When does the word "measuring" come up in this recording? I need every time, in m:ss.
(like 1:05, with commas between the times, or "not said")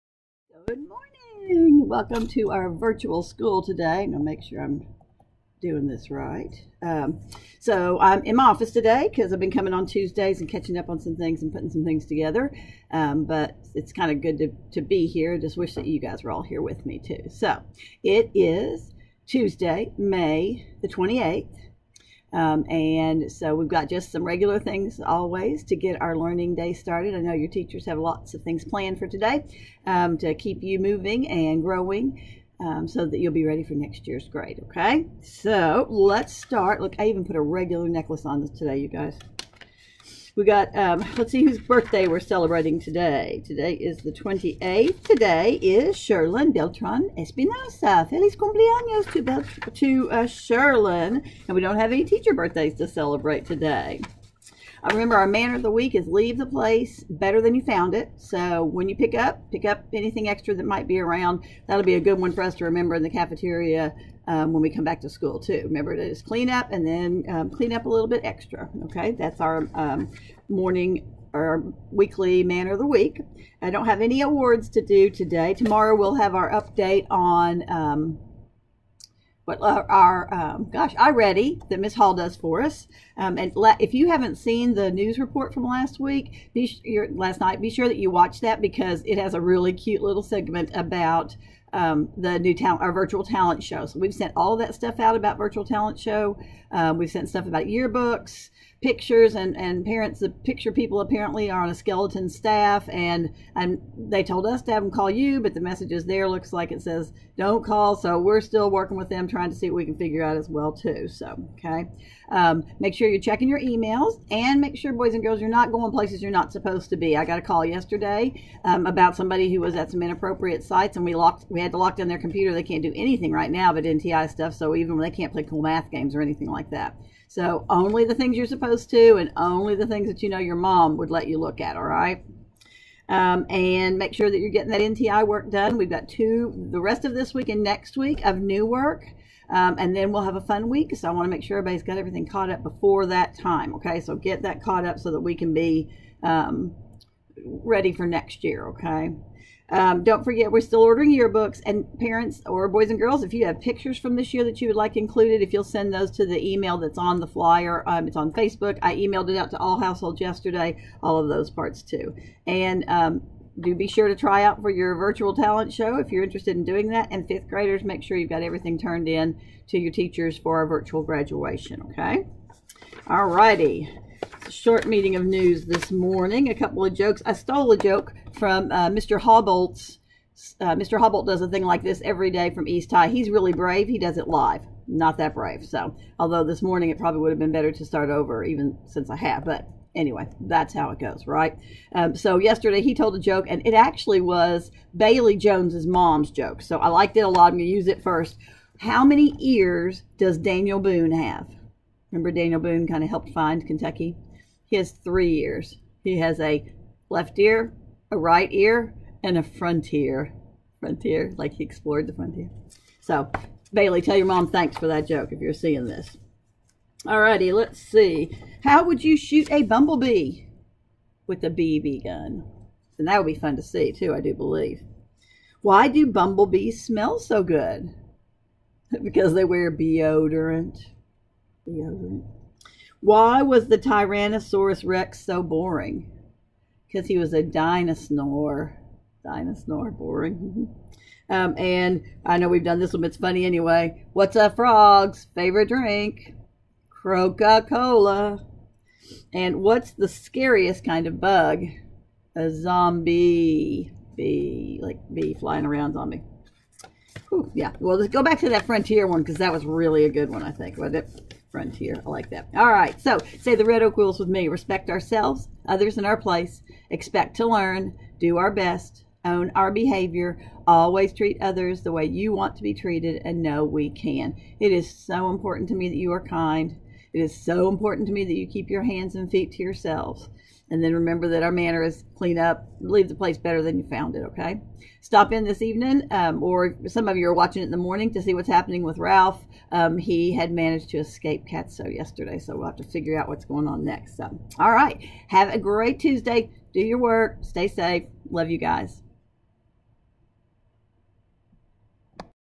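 not said.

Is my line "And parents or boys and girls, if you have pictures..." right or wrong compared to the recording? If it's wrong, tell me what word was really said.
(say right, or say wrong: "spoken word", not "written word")
right.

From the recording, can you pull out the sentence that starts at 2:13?
Um, and make sure that you're getting that NTI work done.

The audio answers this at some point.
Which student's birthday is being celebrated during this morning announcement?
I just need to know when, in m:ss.
0:45.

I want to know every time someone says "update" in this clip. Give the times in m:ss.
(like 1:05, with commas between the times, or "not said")
1:16.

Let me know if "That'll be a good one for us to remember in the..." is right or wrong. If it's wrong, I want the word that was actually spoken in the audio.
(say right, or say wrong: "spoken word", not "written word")
right.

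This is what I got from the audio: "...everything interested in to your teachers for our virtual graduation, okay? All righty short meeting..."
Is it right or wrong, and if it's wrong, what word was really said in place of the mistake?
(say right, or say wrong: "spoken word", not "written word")
wrong: "turned", not "interested".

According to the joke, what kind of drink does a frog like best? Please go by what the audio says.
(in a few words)
Coca Cola.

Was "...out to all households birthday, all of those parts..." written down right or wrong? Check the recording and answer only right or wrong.
wrong.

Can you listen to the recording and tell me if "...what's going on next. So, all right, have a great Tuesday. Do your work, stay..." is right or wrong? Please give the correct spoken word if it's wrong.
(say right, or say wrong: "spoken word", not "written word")
right.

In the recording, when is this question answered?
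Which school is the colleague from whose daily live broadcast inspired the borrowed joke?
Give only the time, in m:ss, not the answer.
3:02.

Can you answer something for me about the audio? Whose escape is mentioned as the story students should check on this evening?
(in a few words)
Ralph.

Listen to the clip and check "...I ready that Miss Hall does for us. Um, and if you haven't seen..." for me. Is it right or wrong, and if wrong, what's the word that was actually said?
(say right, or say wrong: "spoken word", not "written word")
right.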